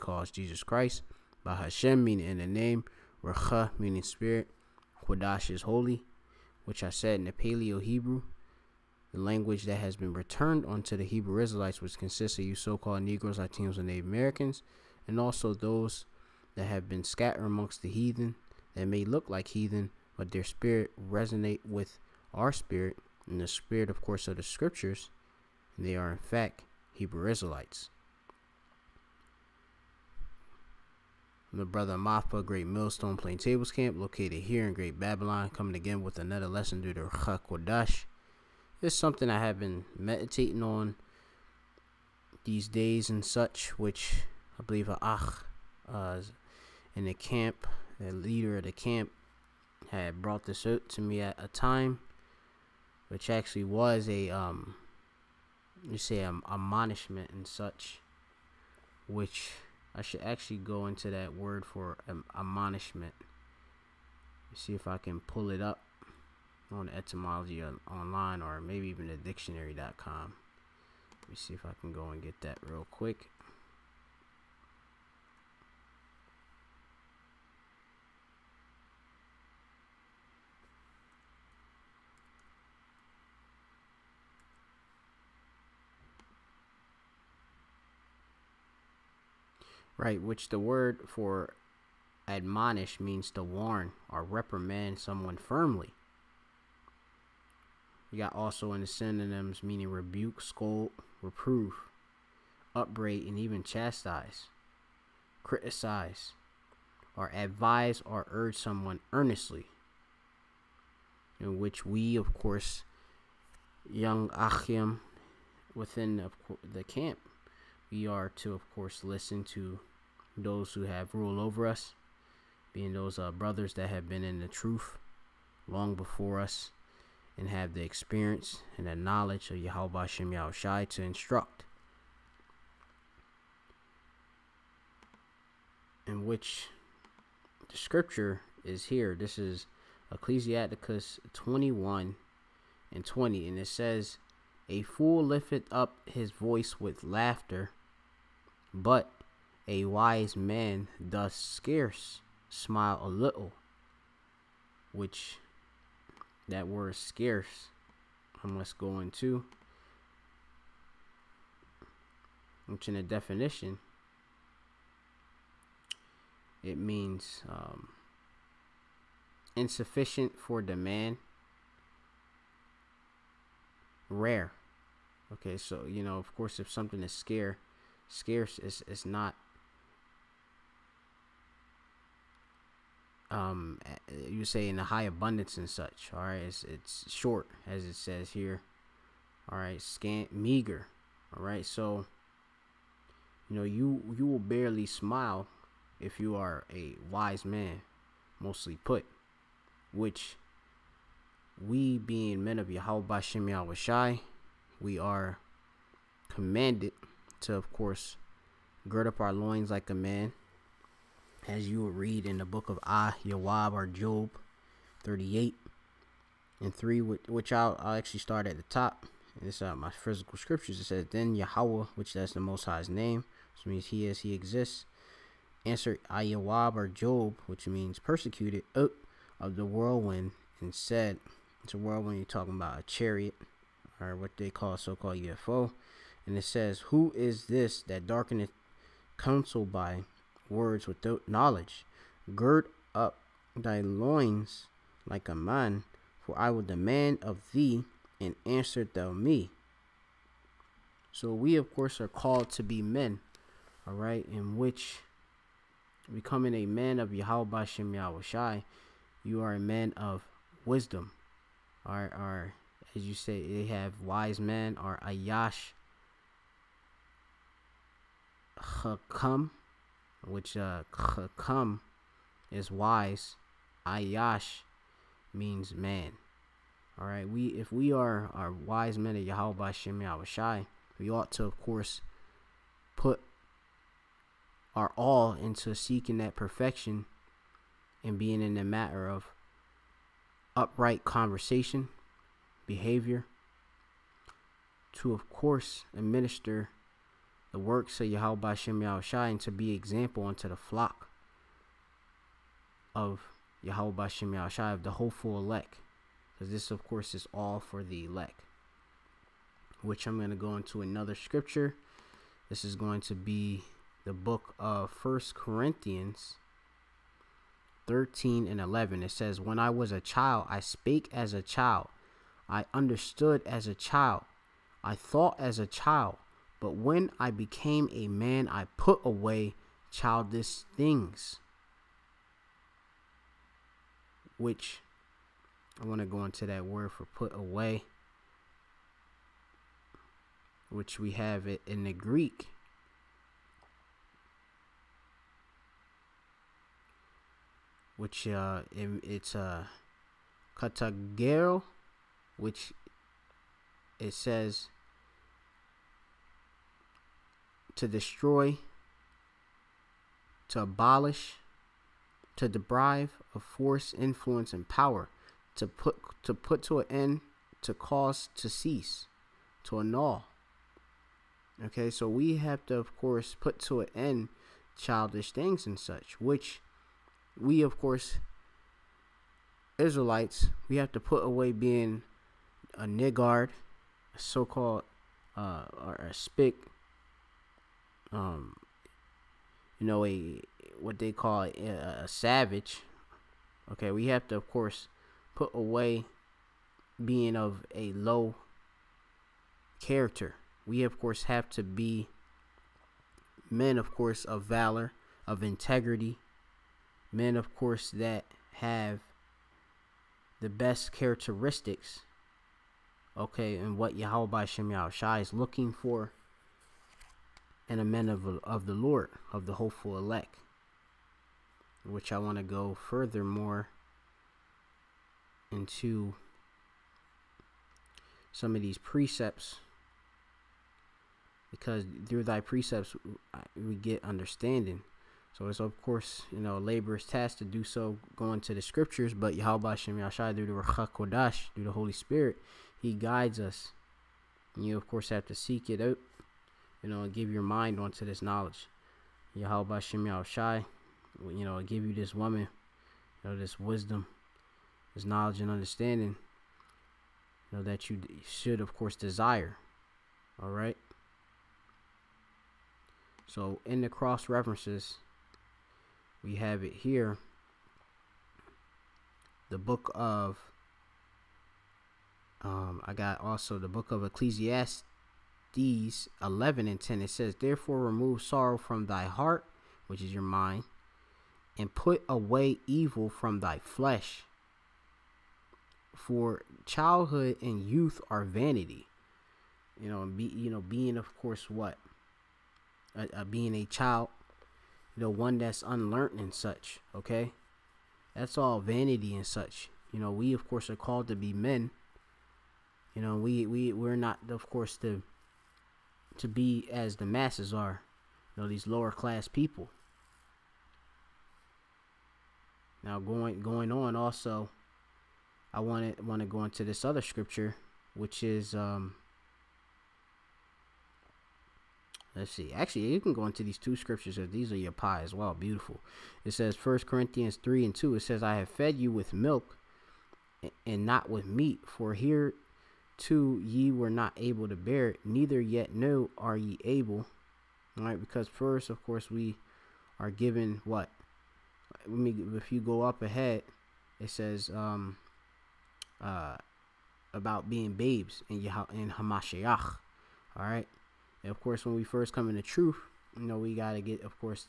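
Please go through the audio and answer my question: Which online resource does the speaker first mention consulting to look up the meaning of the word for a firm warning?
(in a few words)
etymology online.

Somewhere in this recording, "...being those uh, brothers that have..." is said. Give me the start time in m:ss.
2:02.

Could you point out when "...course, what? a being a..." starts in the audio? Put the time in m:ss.
8:11.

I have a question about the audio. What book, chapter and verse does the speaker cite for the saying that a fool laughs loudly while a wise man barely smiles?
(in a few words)
Ecclesiasticus 21:20.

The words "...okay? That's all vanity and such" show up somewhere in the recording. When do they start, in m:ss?
8:16.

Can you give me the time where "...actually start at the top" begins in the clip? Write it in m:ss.
3:37.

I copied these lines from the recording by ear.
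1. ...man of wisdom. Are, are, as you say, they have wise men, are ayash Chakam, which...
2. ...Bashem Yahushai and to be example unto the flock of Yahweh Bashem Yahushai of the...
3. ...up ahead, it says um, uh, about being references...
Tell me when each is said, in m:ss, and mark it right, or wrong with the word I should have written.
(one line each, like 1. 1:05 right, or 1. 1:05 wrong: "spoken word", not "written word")
1. 4:19 right
2. 4:58 right
3. 9:02 wrong: "babes", not "references".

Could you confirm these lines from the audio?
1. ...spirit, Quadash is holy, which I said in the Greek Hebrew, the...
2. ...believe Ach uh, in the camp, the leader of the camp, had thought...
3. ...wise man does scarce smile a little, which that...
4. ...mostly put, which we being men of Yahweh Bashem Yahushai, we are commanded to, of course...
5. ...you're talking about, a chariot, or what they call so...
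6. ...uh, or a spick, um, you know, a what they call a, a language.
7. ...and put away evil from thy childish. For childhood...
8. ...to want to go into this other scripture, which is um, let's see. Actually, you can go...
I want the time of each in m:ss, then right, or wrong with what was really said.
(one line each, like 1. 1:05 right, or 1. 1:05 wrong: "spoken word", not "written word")
1. 0:04 wrong: "Paleo", not "Greek"
2. 0:44 wrong: "brought", not "thought"
3. 2:29 right
4. 3:18 right
5. 3:52 right
6. 6:25 wrong: "savage", not "language"
7. 8:01 wrong: "flesh", not "childish"
8. 8:35 right.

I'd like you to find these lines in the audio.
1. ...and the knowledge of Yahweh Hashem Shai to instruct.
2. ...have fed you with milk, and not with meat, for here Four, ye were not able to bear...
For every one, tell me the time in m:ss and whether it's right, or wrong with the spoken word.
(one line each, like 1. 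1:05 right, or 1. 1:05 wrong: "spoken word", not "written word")
1. 2:08 wrong: "Yahushai", not "Shai"
2. 8:48 wrong: "Two", not "Four".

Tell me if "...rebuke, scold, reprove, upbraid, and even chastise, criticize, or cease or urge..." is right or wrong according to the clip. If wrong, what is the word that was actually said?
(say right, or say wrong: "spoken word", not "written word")
wrong: "advise", not "cease".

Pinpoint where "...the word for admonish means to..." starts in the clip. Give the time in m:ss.
1:30.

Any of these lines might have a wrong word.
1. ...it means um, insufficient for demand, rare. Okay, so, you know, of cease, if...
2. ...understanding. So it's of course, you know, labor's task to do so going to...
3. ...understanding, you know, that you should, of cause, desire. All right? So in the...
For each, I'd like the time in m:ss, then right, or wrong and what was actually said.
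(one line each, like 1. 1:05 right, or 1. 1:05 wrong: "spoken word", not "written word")
1. 2:46 wrong: "course", not "cease"
2. 7:14 right
3. 7:35 wrong: "course", not "cause".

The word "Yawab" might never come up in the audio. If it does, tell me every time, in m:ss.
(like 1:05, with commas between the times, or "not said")
3:33, 3:46.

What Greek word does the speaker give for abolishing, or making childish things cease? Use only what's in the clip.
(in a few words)
katagero.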